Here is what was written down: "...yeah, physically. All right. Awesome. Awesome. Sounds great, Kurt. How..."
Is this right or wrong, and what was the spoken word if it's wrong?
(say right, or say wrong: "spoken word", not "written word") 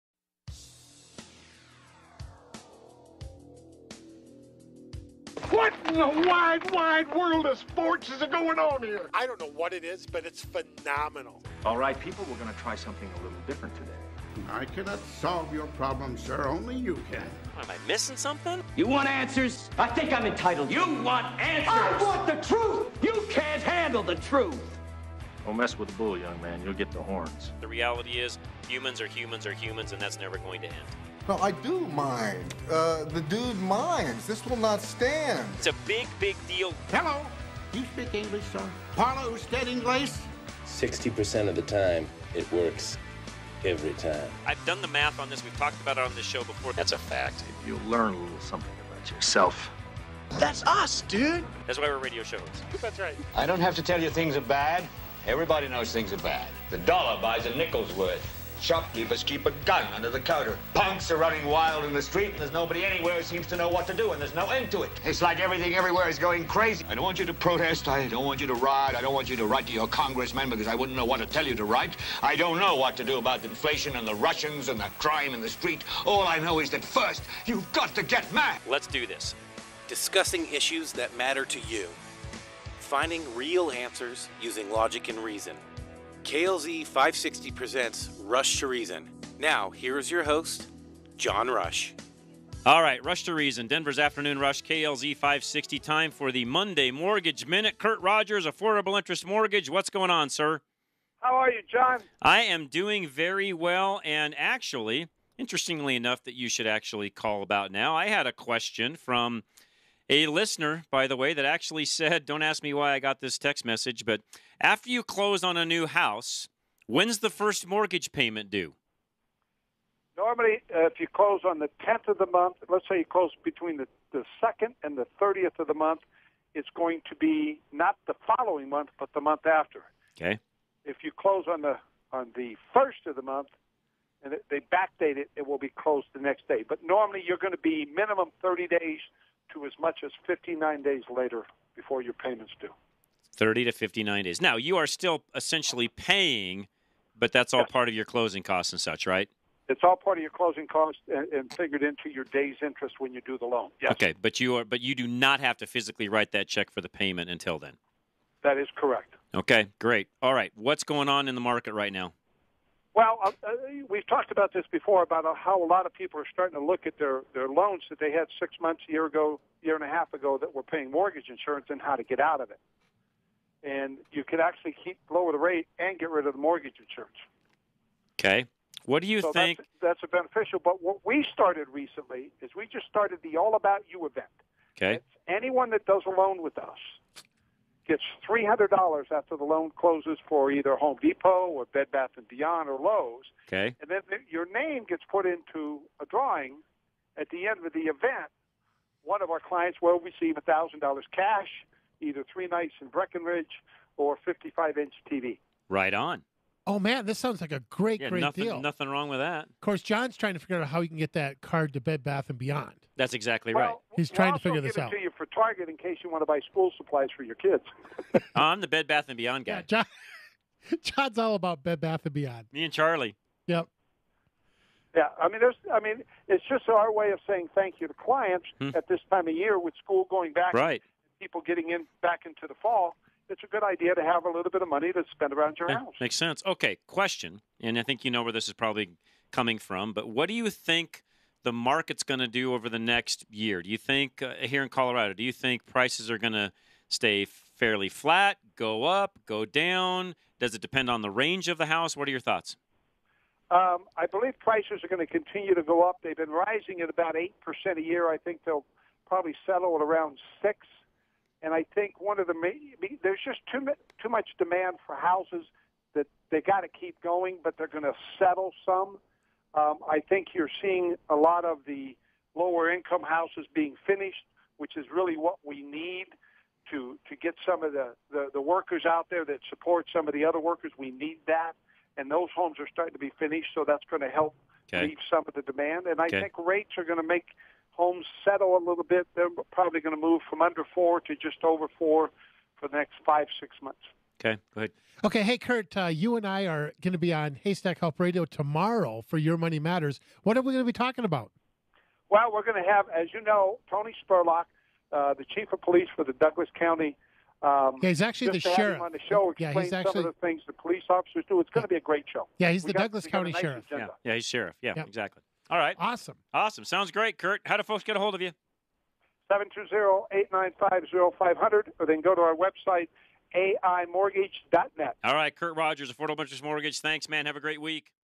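wrong: "exactly", not "physically".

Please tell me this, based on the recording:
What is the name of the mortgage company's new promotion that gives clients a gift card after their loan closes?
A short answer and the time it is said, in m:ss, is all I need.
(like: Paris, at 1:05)
All About You, at 3:03.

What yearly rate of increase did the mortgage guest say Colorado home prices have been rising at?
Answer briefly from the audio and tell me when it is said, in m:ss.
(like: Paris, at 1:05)
8%, at 4:17.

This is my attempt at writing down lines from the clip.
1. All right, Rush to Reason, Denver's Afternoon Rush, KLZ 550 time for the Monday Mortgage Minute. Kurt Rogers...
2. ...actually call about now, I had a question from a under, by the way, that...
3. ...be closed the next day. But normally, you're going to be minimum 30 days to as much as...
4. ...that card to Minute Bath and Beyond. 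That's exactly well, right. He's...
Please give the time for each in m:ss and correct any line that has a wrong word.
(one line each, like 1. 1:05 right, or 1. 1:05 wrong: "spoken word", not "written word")
1. 1:32 wrong: "560", not "550"
2. 1:46 wrong: "listener", not "under"
3. 2:15 right
4. 3:31 wrong: "Bed", not "Minute".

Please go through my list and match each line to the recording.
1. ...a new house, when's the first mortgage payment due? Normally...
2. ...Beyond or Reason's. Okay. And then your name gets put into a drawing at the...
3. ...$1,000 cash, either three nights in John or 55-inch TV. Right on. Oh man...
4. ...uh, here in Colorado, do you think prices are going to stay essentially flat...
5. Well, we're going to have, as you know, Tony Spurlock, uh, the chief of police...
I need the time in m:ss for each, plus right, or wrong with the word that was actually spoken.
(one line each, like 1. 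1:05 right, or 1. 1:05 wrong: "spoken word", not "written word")
1. 1:55 right
2. 3:12 wrong: "Lowe", not "Reason"
3. 3:20 wrong: "Breckenridge", not "John"
4. 4:04 wrong: "fairly", not "essentially"
5. 5:02 right.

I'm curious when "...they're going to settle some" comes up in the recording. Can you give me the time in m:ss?
4:27.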